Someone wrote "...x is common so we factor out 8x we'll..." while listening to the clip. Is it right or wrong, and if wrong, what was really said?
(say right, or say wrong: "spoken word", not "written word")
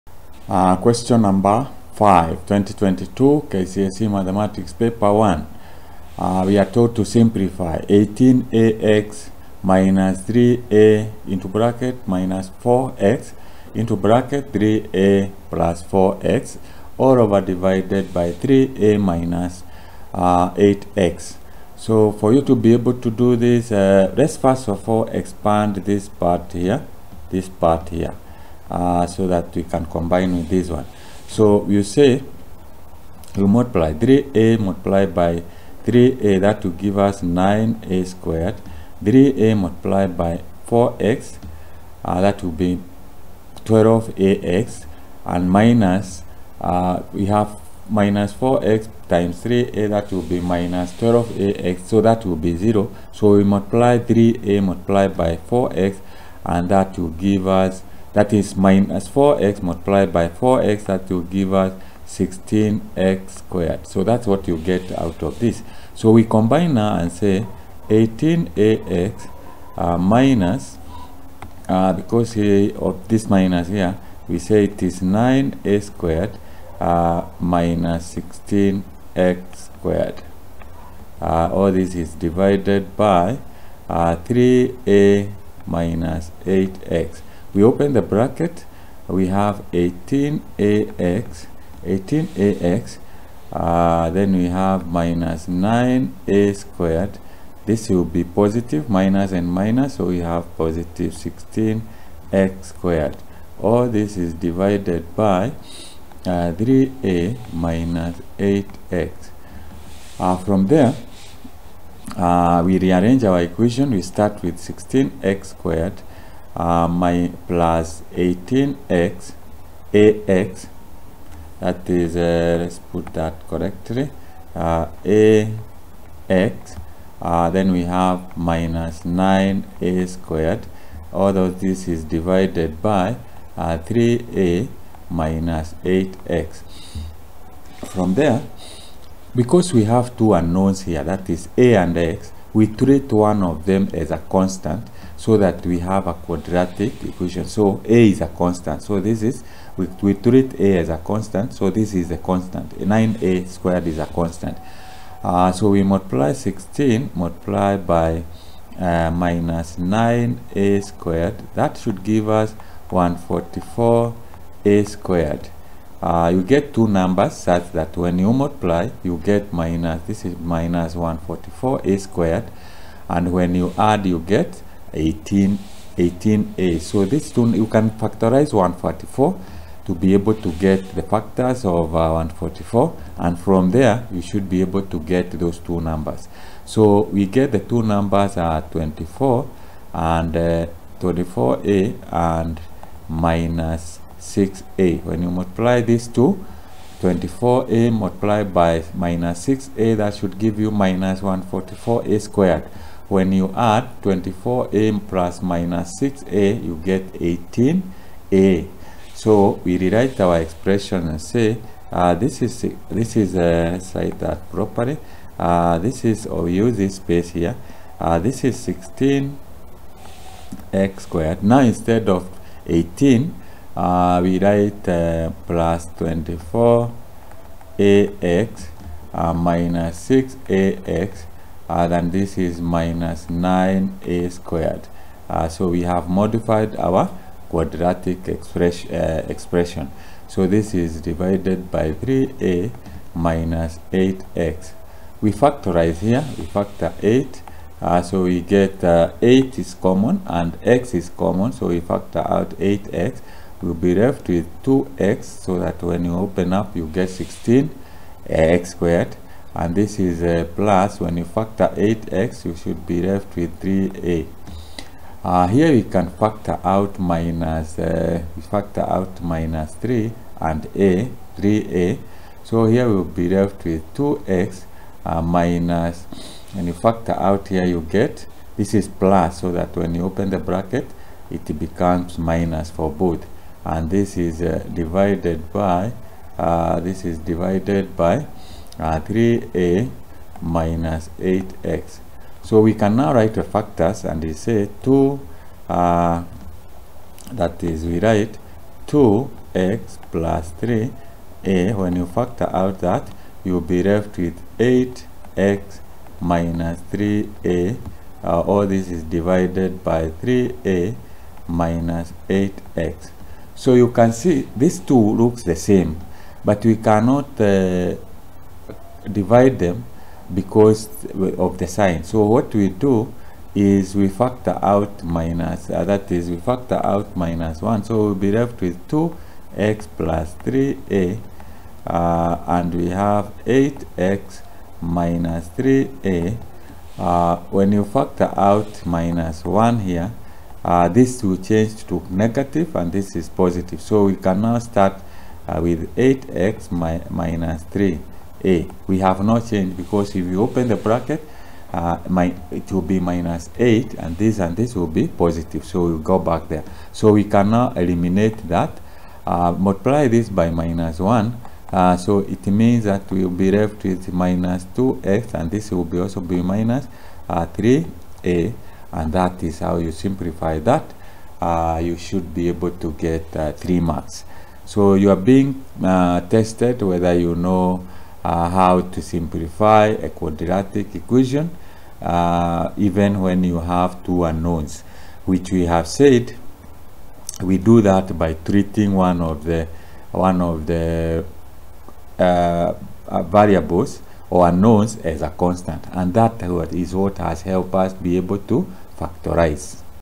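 right.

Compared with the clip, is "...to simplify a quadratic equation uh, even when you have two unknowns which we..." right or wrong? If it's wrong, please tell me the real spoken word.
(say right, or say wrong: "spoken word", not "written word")
right.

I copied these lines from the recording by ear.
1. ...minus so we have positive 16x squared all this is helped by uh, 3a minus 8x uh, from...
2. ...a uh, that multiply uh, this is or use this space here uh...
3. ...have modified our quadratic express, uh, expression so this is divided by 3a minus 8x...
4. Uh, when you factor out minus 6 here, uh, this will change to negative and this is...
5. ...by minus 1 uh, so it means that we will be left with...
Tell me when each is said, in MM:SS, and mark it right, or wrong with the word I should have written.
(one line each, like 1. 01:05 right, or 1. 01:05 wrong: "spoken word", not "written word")
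1. 01:39 wrong: "divided", not "helped"
2. 03:33 wrong: "properly", not "multiply"
3. 03:55 right
4. 05:36 wrong: "1", not "6"
5. 06:00 right.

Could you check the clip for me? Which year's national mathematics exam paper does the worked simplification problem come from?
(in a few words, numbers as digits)
2022.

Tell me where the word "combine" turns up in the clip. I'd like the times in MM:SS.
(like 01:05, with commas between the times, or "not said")
00:29, 01:06.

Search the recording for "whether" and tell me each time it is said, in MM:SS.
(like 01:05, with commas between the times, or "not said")
06:16.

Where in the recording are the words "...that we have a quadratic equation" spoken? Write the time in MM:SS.
02:25.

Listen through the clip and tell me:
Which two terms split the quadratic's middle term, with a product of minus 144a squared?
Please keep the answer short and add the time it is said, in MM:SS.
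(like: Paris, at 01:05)
24a and minus 6a, at 03:11.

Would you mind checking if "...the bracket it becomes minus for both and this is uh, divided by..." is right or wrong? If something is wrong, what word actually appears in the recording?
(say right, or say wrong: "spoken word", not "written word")
right.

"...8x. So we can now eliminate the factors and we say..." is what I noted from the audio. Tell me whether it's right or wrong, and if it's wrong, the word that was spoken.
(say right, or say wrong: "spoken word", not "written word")
wrong: "write", not "eliminate".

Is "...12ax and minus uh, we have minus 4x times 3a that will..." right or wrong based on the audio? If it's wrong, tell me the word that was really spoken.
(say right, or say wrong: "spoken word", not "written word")
right.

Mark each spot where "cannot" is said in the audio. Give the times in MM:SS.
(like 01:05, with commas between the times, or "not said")
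05:16.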